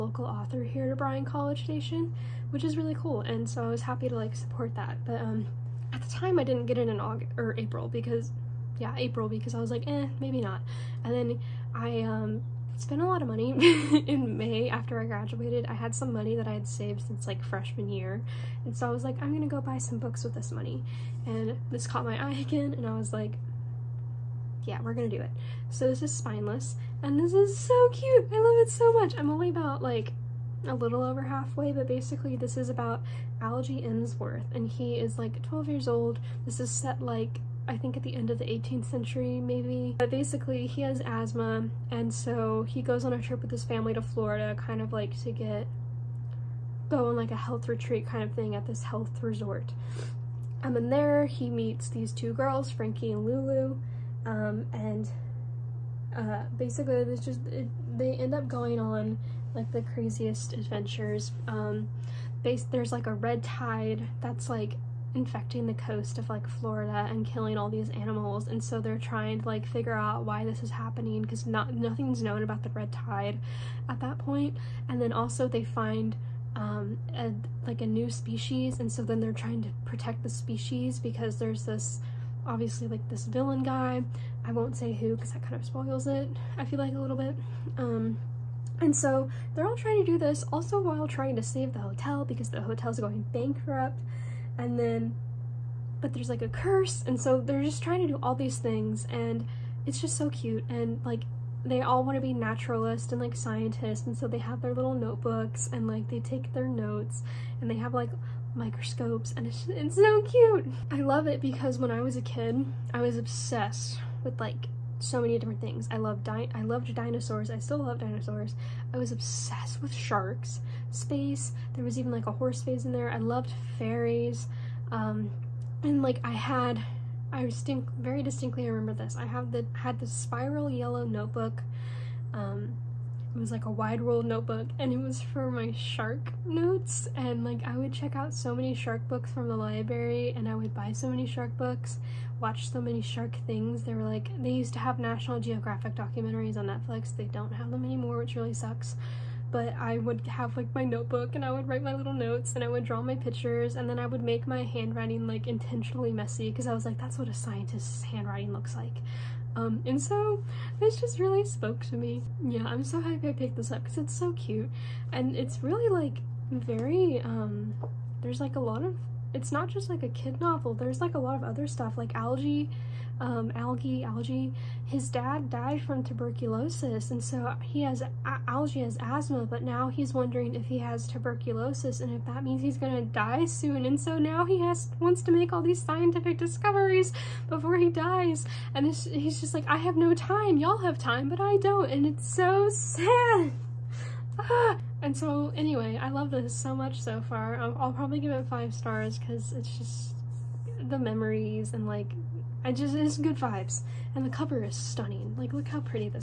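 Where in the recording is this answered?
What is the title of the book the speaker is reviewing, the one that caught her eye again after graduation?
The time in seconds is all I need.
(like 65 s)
26 s.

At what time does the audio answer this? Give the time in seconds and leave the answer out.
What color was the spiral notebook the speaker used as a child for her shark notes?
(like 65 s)
130 s.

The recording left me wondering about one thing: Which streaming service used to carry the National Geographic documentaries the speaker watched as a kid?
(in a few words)
Netflix.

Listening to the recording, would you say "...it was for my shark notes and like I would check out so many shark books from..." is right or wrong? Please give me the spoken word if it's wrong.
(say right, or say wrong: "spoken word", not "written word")
right.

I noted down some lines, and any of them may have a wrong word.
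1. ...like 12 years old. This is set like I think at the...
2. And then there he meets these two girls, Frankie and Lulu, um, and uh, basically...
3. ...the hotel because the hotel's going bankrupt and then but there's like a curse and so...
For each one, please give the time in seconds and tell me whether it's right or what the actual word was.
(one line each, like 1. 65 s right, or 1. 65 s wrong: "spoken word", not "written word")
1. 35 s right
2. 50 s right
3. 91 s right.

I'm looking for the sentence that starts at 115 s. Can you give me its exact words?
I loved di I loved dinosaurs.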